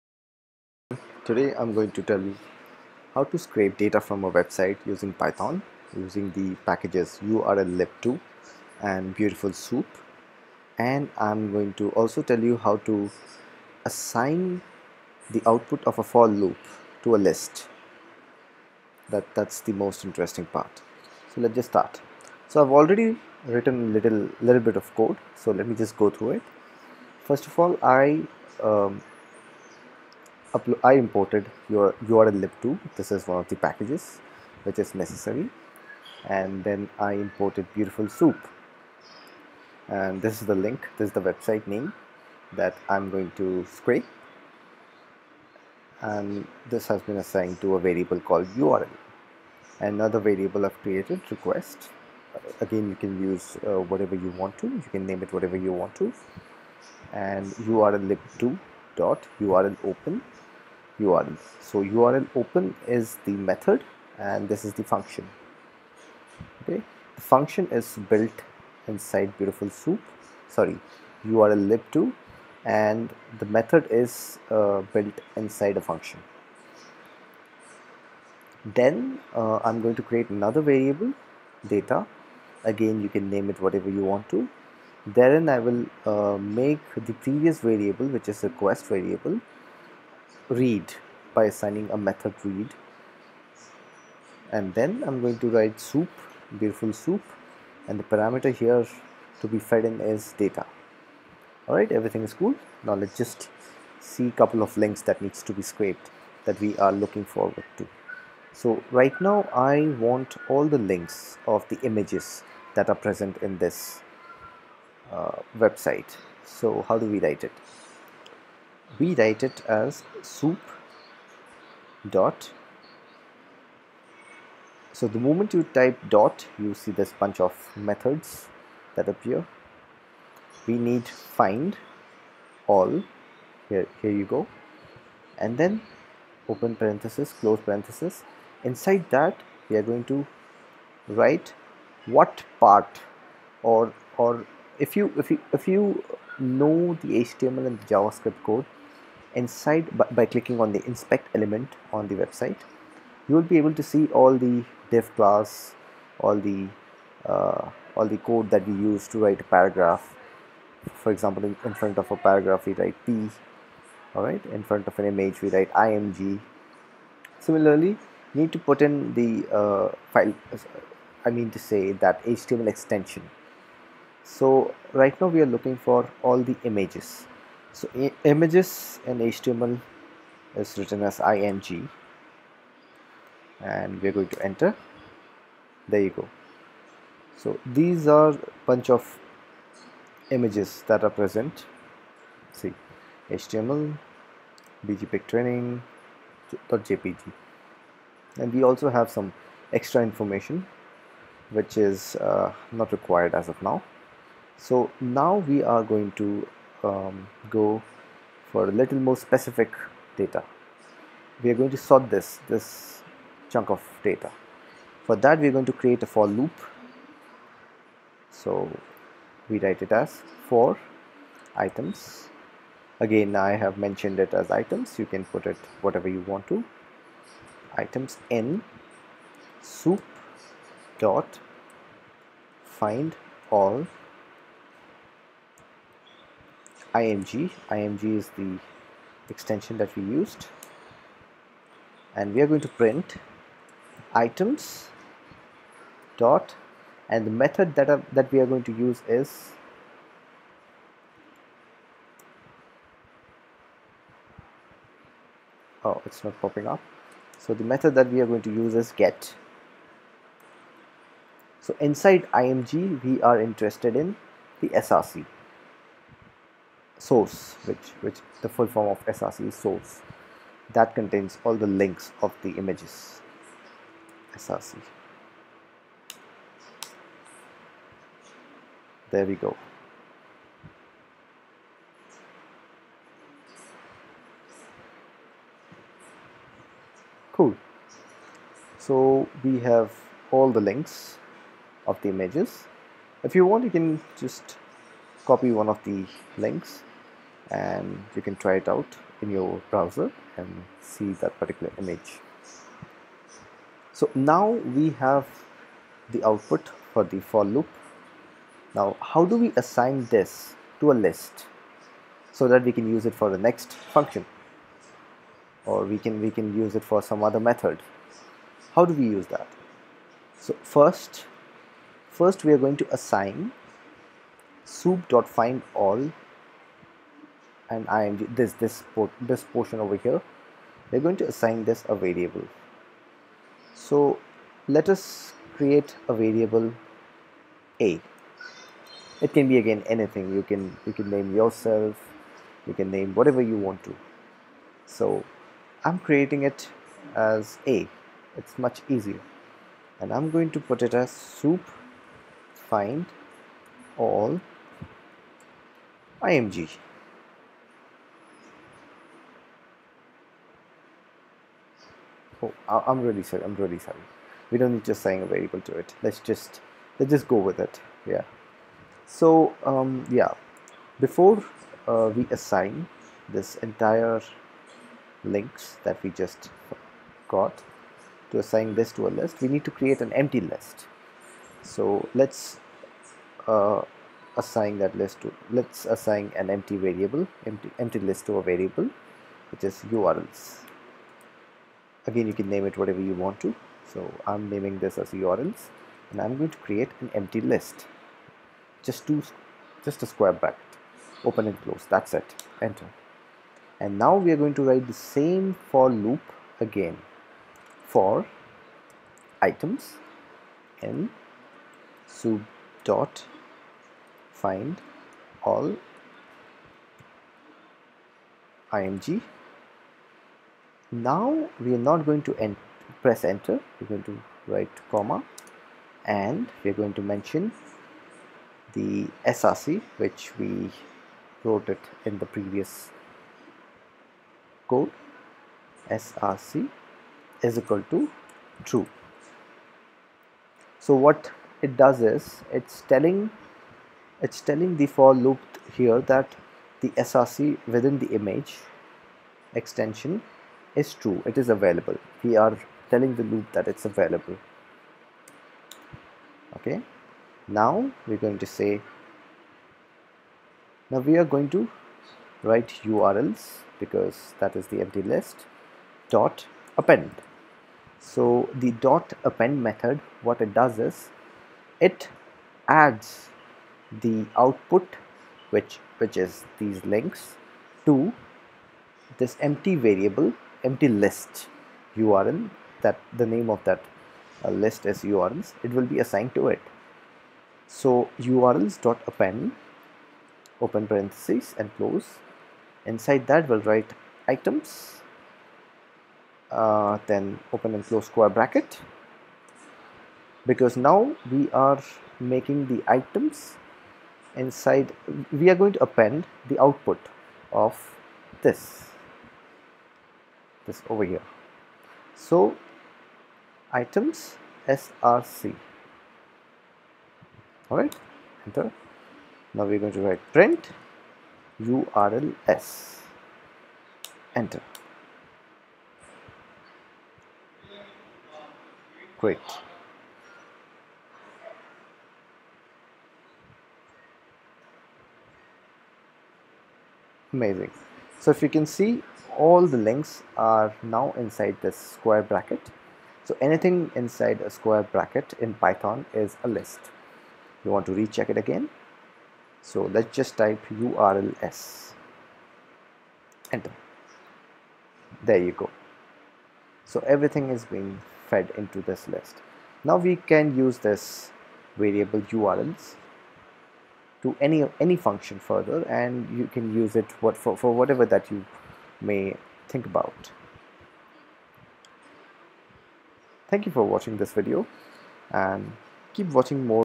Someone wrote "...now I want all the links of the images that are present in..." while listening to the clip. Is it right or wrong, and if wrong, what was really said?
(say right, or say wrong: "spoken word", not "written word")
right.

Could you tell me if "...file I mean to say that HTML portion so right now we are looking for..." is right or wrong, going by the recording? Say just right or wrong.
wrong.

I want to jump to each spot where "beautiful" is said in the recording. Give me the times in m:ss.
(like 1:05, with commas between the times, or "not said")
0:09, 0:37, 1:09, 1:36.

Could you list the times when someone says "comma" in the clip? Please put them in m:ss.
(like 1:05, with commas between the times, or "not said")
7:04.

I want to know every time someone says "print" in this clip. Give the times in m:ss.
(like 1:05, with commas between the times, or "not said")
4:02, 8:40.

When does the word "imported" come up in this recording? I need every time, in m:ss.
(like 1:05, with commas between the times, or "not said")
0:30, 0:37.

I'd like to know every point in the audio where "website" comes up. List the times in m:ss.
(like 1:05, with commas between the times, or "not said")
0:04, 0:41, 1:55, 2:32.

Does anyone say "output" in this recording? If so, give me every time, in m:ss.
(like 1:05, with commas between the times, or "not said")
0:15, 5:06, 7:54, 8:26.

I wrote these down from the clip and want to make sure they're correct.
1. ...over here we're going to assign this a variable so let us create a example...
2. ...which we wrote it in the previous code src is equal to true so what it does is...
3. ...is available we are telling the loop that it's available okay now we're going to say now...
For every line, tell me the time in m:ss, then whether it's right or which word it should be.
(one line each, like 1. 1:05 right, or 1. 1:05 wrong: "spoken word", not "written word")
1. 5:29 wrong: "variable", not "example"
2. 7:09 right
3. 7:31 right.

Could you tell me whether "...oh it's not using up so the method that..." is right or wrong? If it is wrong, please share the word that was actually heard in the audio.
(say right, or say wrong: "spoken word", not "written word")
wrong: "popping", not "using".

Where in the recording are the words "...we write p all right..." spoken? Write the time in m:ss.
2:42.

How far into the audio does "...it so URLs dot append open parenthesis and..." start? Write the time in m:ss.
8:06.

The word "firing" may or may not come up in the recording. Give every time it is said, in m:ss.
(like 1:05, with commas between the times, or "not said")
not said.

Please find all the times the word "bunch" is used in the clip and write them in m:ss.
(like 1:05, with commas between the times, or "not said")
2:07, 3:08.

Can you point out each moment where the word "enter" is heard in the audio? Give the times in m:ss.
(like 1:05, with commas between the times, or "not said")
3:04, 6:42, 7:03, 8:38, 8:44, 9:13.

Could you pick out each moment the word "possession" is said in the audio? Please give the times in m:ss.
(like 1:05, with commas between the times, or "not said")
not said.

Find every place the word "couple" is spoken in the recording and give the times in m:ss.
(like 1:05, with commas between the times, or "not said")
1:44.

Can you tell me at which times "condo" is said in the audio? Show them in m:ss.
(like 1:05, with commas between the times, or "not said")
not said.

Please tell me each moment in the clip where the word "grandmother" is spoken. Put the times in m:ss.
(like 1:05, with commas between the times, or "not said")
not said.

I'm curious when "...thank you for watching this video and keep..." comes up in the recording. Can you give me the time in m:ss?
9:33.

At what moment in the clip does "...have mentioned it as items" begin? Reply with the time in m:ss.
3:43.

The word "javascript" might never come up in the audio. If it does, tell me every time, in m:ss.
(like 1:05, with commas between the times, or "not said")
2:27.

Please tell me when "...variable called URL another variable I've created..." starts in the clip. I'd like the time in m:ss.
0:47.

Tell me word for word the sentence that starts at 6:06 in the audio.
Let's just, let's just go with it.